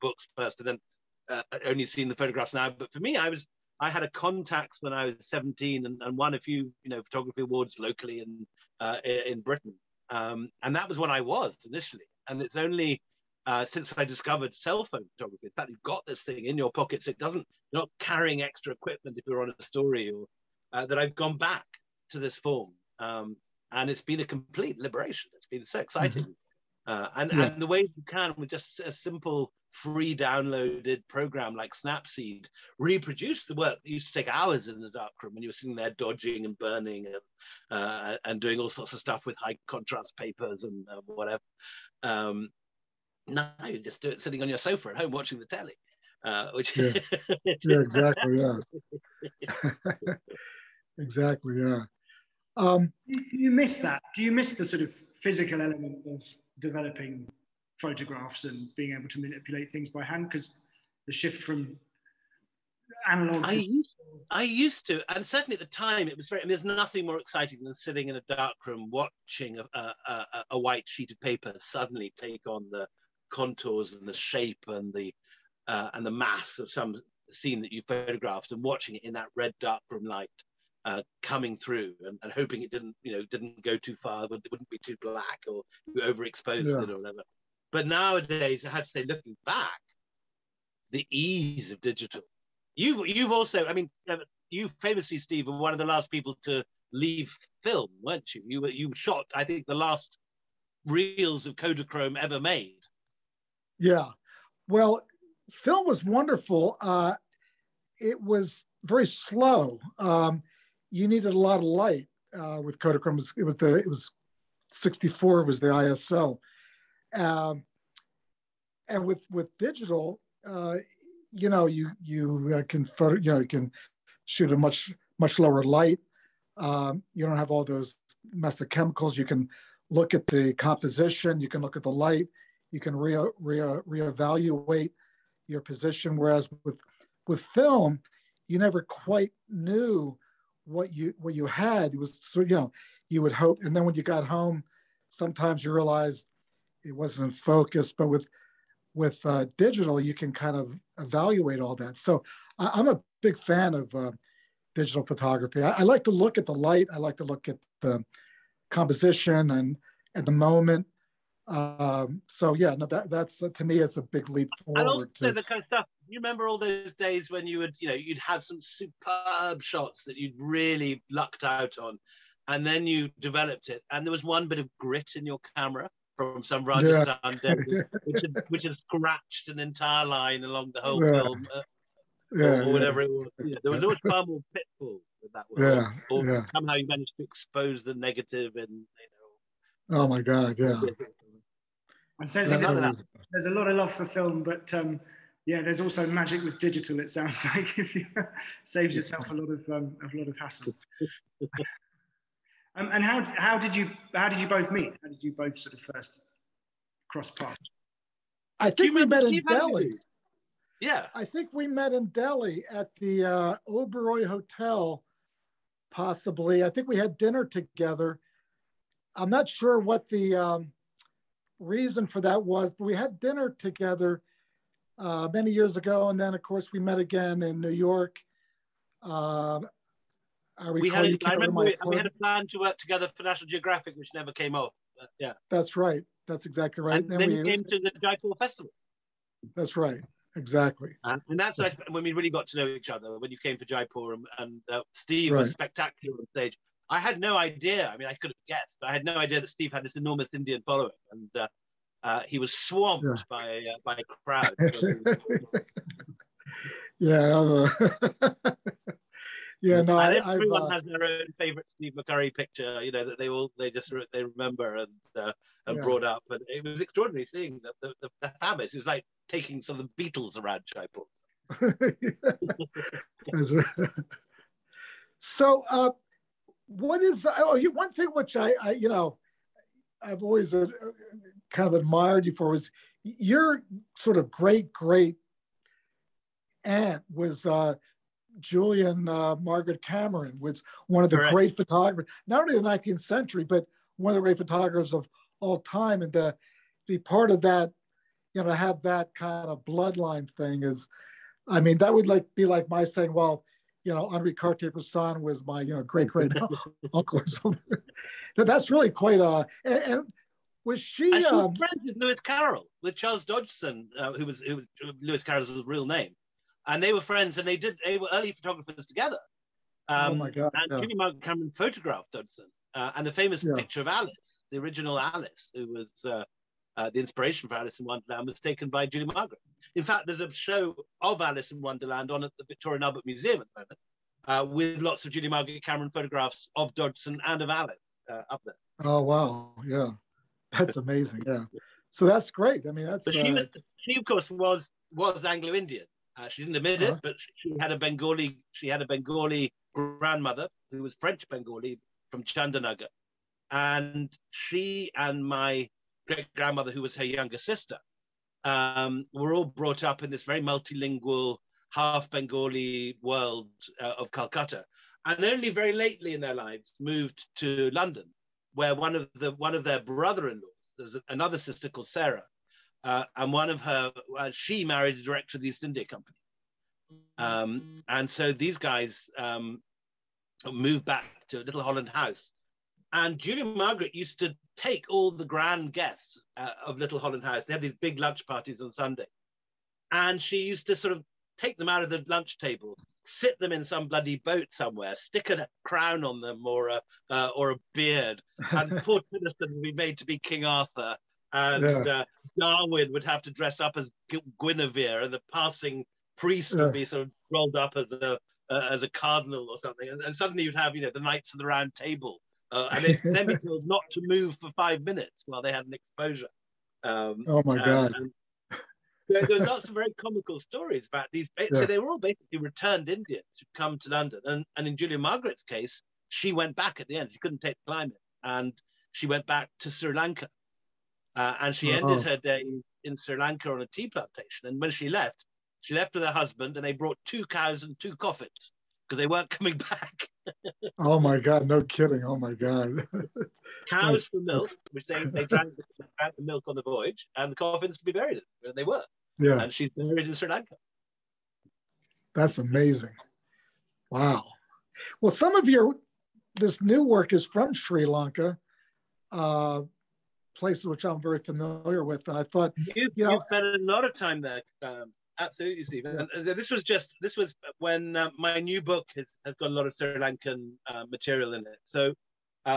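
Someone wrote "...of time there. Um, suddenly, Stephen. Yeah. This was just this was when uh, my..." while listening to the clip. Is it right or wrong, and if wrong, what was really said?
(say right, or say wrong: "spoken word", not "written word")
wrong: "absolutely", not "suddenly".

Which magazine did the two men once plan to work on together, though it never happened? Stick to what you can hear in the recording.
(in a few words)
National Geographic.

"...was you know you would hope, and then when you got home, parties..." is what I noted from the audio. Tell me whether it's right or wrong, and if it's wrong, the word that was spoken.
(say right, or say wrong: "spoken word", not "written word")
wrong: "sometimes", not "parties".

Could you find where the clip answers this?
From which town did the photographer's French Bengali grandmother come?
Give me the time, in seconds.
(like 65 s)
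352 s.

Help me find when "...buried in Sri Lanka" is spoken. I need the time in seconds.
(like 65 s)
449 s.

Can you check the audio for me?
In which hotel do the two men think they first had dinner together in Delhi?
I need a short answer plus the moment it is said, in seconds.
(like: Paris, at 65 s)
Oberoi Hotel, at 213 s.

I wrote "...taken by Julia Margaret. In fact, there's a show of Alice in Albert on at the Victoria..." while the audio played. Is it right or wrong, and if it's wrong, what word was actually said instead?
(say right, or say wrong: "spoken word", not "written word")
wrong: "Wonderland", not "Albert".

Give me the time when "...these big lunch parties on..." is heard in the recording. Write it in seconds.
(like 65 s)
387 s.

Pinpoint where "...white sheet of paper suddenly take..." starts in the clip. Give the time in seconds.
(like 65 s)
70 s.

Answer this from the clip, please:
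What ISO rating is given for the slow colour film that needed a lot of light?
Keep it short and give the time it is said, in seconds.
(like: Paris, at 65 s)
64, at 114 s.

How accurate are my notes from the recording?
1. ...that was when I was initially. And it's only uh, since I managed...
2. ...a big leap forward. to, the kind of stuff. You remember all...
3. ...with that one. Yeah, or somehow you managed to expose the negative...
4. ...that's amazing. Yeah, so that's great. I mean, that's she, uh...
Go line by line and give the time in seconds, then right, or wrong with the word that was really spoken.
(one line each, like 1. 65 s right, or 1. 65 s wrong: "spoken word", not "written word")
1. 10 s wrong: "discovered", not "managed"
2. 163 s right
3. 185 s right
4. 340 s right.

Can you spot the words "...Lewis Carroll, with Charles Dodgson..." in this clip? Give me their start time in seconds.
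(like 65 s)
311 s.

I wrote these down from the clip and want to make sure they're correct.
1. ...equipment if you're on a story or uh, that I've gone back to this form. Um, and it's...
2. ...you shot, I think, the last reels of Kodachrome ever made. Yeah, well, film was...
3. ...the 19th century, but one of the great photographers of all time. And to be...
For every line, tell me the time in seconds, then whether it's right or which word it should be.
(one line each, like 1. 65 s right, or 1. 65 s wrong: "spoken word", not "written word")
1. 18 s right
2. 98 s right
3. 292 s right.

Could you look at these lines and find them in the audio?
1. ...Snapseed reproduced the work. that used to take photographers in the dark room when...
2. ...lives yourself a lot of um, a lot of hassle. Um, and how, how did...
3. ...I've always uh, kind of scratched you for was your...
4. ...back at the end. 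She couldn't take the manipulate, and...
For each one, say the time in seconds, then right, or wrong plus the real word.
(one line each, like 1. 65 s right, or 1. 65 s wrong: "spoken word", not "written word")
1. 31 s wrong: "hours", not "photographers"
2. 198 s wrong: "saves", not "lives"
3. 280 s wrong: "admired", not "scratched"
4. 426 s wrong: "climate", not "manipulate".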